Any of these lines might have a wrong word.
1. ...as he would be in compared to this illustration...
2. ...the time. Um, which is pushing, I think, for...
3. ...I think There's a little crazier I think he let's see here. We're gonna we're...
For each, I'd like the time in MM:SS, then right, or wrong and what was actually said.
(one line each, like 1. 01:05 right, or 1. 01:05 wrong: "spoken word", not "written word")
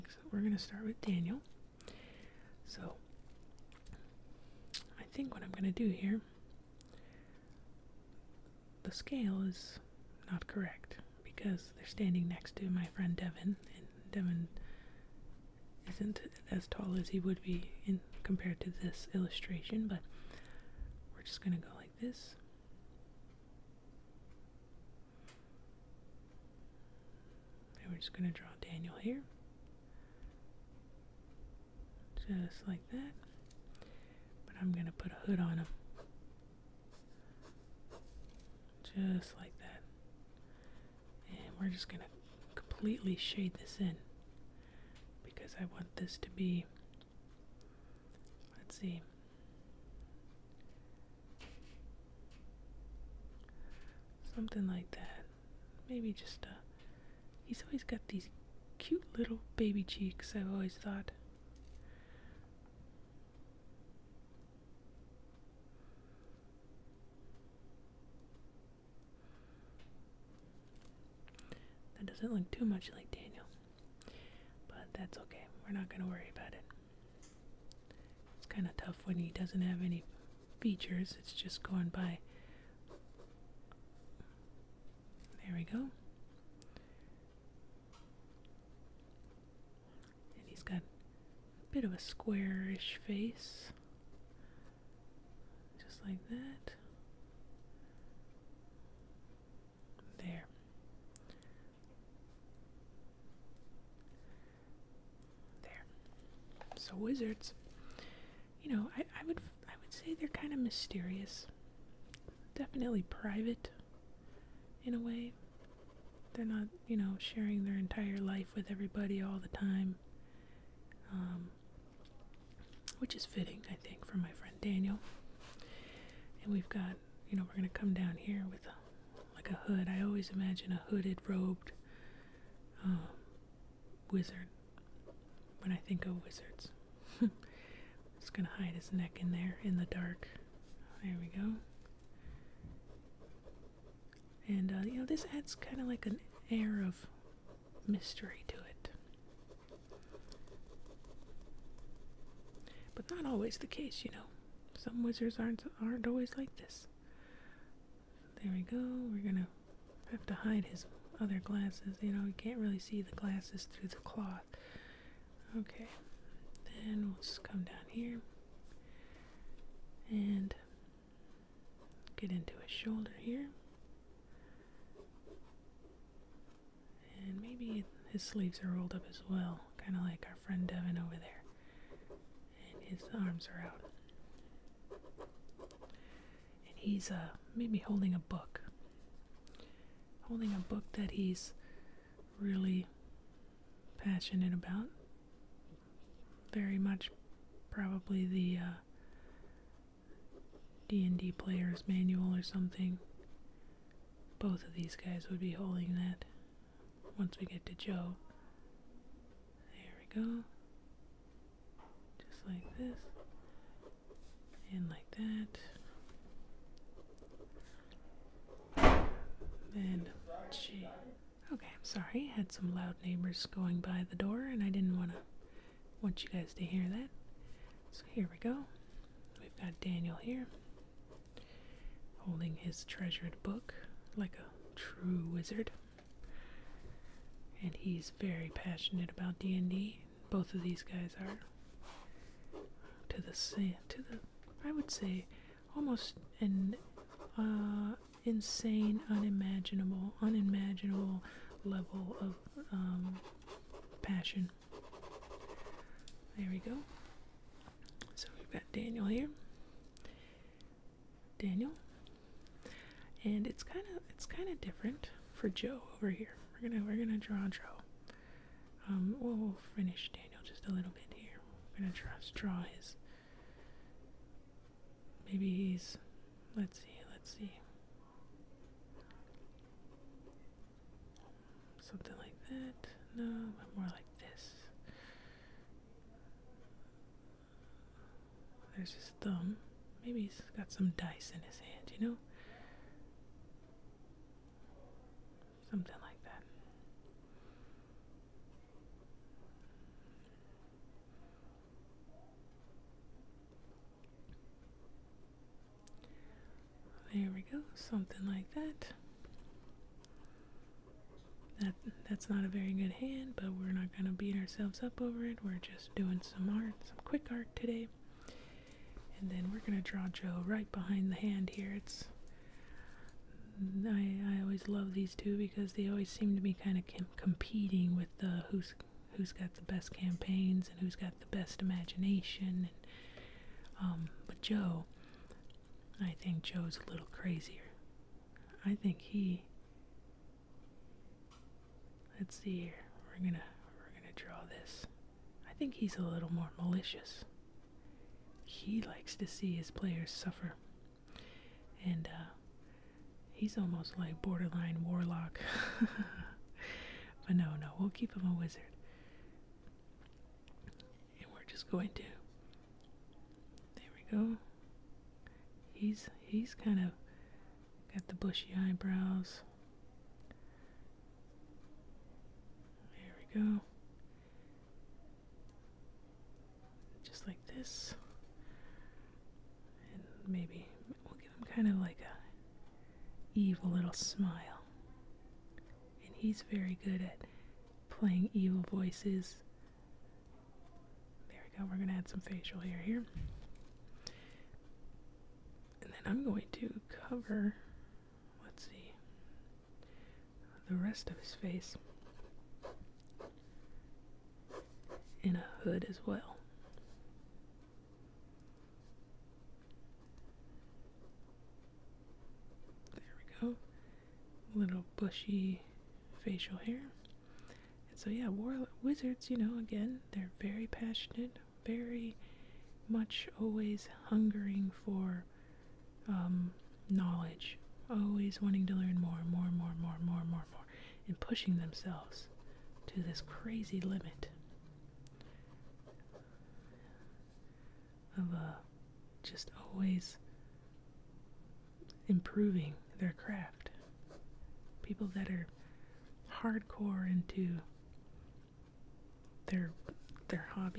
1. 00:16 right
2. 01:59 wrong: "fitting", not "pushing"
3. 05:35 wrong: "Joe", not "There".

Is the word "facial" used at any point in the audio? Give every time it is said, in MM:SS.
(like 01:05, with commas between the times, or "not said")
06:32, 06:56.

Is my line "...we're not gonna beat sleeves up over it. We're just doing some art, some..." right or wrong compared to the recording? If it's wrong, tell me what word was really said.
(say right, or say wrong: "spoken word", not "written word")
wrong: "ourselves", not "sleeves".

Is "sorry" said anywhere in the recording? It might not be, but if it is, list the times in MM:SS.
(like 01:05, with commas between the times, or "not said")
03:41.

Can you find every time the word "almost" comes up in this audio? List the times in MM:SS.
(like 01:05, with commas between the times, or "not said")
04:05, 05:53.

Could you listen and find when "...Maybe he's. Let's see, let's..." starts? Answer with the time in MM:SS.
04:35.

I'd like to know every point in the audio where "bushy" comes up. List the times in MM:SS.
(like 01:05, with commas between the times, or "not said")
06:08, 06:54.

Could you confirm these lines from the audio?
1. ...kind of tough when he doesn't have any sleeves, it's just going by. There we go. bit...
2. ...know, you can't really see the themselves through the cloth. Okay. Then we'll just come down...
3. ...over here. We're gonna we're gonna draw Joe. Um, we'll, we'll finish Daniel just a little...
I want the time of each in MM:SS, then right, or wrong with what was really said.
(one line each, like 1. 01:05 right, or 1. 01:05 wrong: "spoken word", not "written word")
1. 01:18 wrong: "features", not "sleeves"
2. 02:42 wrong: "glasses", not "themselves"
3. 04:25 right.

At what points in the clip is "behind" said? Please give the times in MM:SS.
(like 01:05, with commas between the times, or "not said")
05:20.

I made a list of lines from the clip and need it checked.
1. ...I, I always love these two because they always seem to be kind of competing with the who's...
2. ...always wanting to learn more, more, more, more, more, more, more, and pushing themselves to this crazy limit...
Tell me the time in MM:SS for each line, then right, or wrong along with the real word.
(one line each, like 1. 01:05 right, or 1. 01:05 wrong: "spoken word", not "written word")
1. 05:23 right
2. 07:07 right.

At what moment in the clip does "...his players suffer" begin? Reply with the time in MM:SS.
05:49.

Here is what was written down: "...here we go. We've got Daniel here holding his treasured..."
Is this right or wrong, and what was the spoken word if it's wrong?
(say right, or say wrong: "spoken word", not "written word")
right.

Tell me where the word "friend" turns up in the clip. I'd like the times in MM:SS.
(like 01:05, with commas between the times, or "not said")
00:12, 02:04, 03:00.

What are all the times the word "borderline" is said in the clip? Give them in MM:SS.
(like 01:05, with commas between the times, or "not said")
05:54.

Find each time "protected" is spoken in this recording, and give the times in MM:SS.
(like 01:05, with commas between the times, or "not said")
not said.